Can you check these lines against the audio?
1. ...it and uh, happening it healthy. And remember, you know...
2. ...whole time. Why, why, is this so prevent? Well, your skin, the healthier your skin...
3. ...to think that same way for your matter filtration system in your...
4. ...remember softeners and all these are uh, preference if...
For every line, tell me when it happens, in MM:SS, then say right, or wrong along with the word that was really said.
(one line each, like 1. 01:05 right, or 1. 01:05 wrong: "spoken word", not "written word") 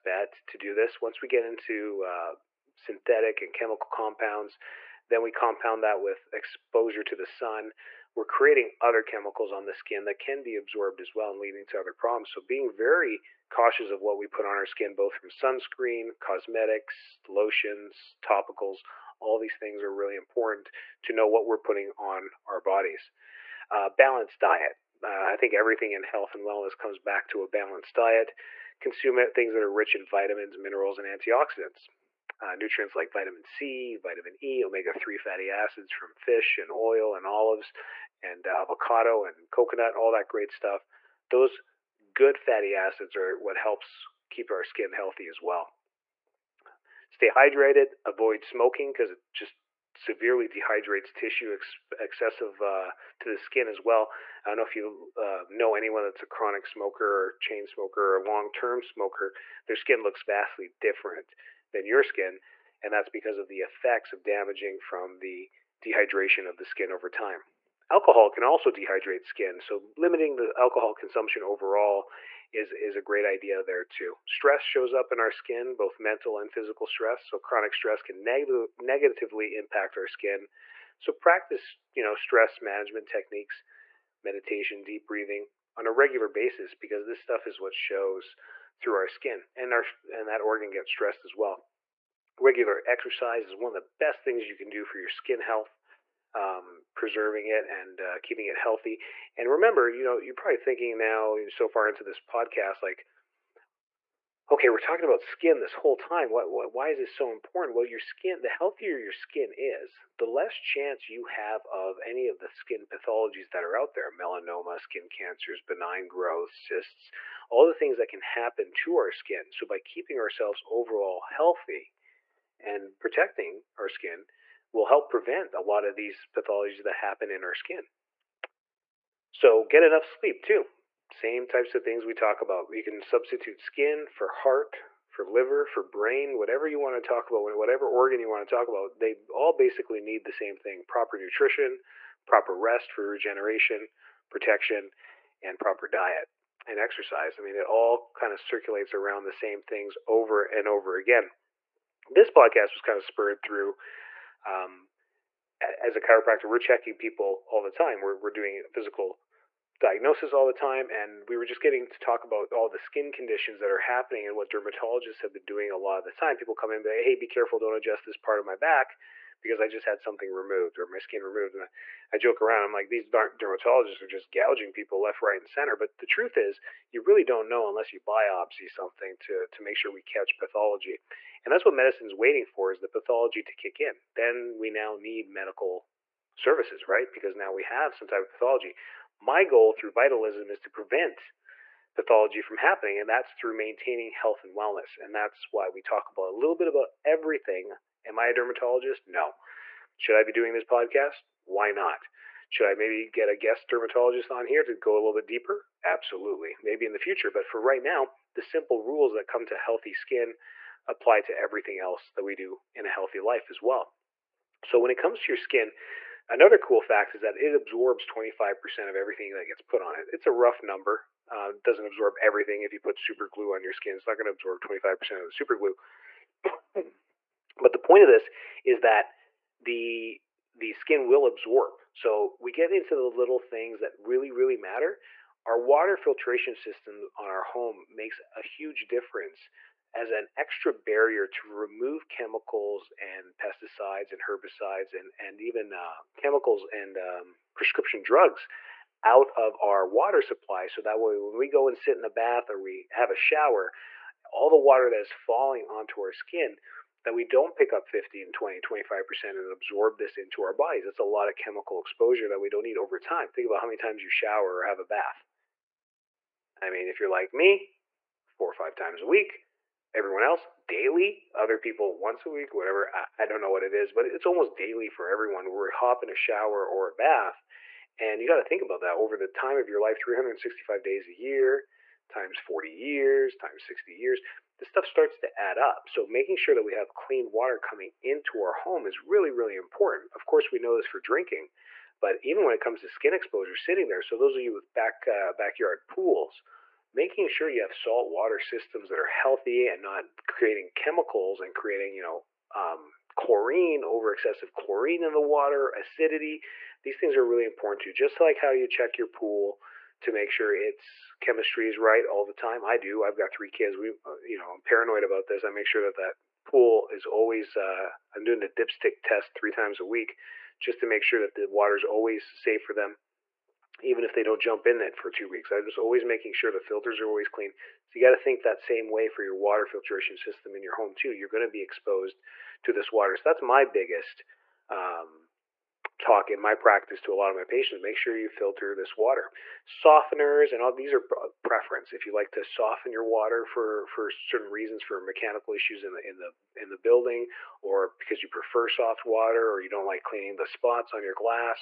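1. 01:37 wrong: "keeping", not "happening"
2. 01:45 wrong: "important", not "prevent"
3. 05:28 wrong: "water", not "matter"
4. 05:38 wrong: "water", not "remember".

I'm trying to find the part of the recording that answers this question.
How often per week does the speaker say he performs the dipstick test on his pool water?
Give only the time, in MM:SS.
05:19.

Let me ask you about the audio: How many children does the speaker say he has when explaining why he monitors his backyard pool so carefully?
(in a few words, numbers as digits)
3.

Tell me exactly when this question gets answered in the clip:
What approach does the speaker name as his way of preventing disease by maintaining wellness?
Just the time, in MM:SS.
03:09.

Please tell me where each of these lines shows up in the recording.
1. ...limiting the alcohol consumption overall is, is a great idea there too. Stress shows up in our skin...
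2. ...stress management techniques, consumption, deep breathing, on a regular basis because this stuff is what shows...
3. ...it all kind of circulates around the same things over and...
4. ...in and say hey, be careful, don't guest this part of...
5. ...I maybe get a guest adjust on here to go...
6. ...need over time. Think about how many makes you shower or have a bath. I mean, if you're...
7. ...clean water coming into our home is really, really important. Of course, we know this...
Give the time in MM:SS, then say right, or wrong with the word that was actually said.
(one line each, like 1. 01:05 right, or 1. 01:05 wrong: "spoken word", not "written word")
1. 01:09 right
2. 01:22 wrong: "meditation", not "consumption"
3. 02:27 right
4. 02:46 wrong: "adjust", not "guest"
5. 03:22 wrong: "dermatologist", not "adjust"
6. 04:22 wrong: "times", not "makes"
7. 04:46 right.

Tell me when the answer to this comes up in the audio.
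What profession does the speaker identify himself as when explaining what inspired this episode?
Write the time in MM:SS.
02:36.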